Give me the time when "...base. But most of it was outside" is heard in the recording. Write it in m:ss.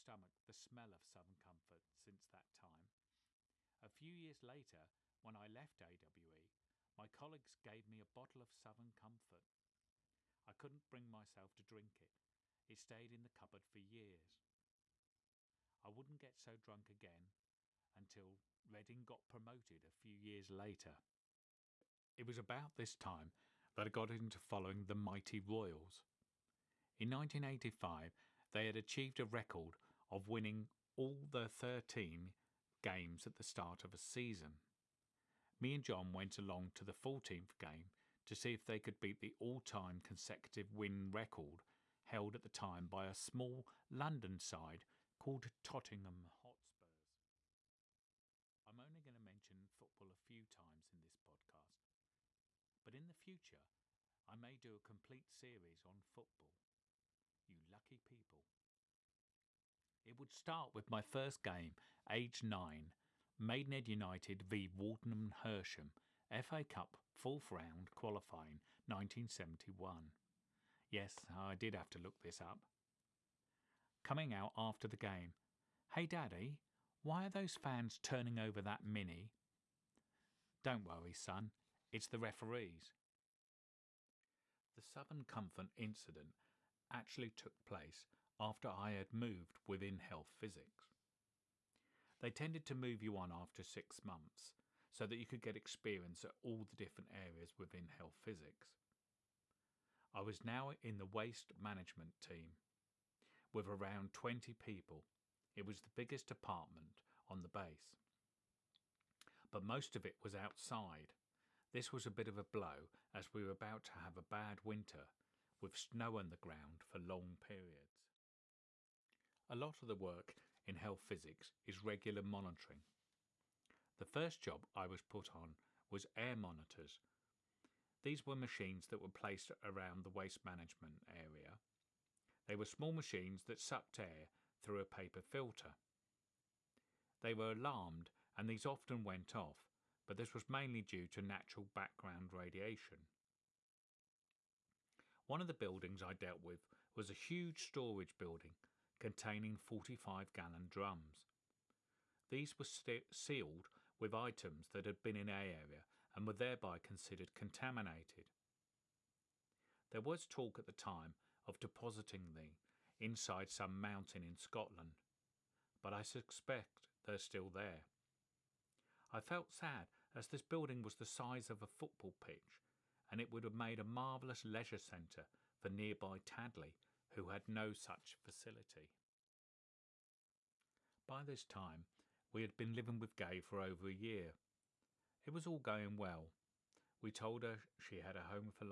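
1:47.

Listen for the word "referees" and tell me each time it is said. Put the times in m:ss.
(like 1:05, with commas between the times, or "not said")
1:22.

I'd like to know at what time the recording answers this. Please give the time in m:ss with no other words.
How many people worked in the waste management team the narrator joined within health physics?
1:44.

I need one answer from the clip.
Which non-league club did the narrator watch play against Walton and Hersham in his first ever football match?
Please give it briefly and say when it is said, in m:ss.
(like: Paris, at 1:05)
Maidenhead United, at 1:03.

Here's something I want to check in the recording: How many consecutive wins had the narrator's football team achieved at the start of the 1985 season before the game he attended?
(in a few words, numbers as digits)
13.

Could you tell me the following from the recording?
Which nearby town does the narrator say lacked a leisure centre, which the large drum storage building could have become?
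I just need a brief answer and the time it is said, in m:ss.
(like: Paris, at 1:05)
Tadley, at 2:56.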